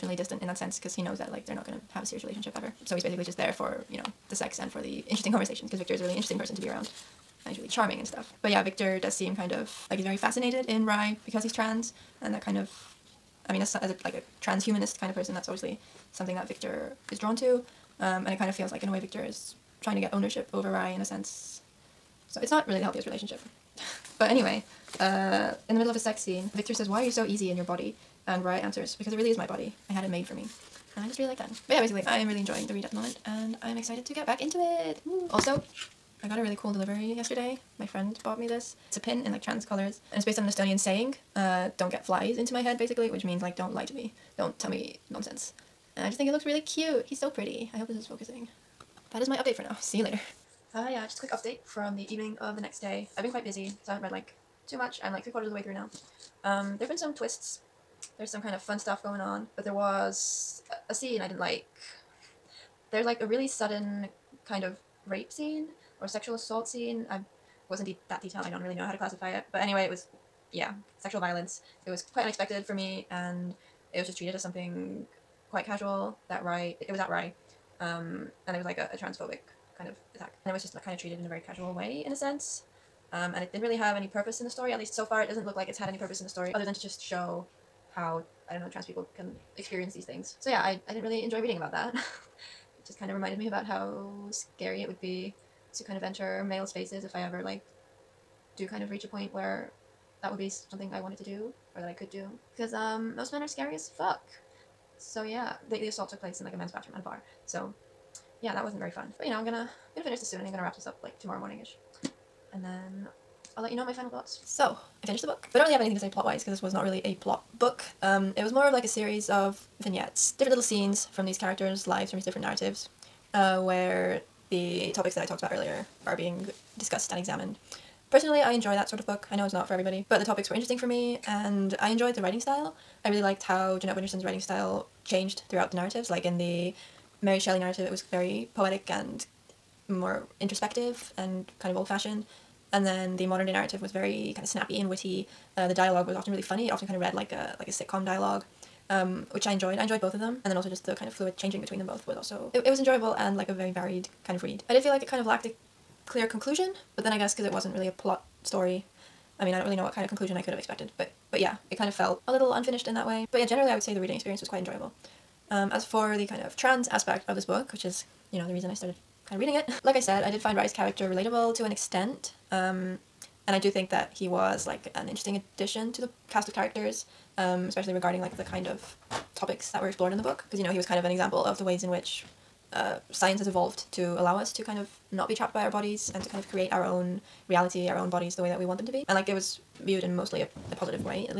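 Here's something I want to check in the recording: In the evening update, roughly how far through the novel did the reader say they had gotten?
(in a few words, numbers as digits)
Three quarters.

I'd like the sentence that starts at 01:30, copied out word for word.
So yeah, I, I didn't really enjoy reading about that.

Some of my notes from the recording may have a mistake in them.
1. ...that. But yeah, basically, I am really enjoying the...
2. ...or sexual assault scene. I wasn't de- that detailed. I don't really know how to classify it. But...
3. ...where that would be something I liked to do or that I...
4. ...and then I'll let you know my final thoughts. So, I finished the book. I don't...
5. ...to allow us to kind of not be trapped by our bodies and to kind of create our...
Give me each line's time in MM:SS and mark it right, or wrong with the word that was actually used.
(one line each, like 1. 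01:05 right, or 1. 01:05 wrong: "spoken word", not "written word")
1. 00:31 right
2. 01:06 right
3. 01:39 wrong: "wanted", not "liked"
4. 01:52 right
5. 03:03 right.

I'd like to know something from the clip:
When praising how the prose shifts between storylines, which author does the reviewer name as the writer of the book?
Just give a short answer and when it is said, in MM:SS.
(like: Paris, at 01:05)
Jeanette Winterson, at 02:13.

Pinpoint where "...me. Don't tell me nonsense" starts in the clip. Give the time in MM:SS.
00:43.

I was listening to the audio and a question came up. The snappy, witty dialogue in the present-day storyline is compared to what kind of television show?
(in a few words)
Sitcom.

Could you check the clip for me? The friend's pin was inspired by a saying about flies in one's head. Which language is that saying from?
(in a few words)
Estonian.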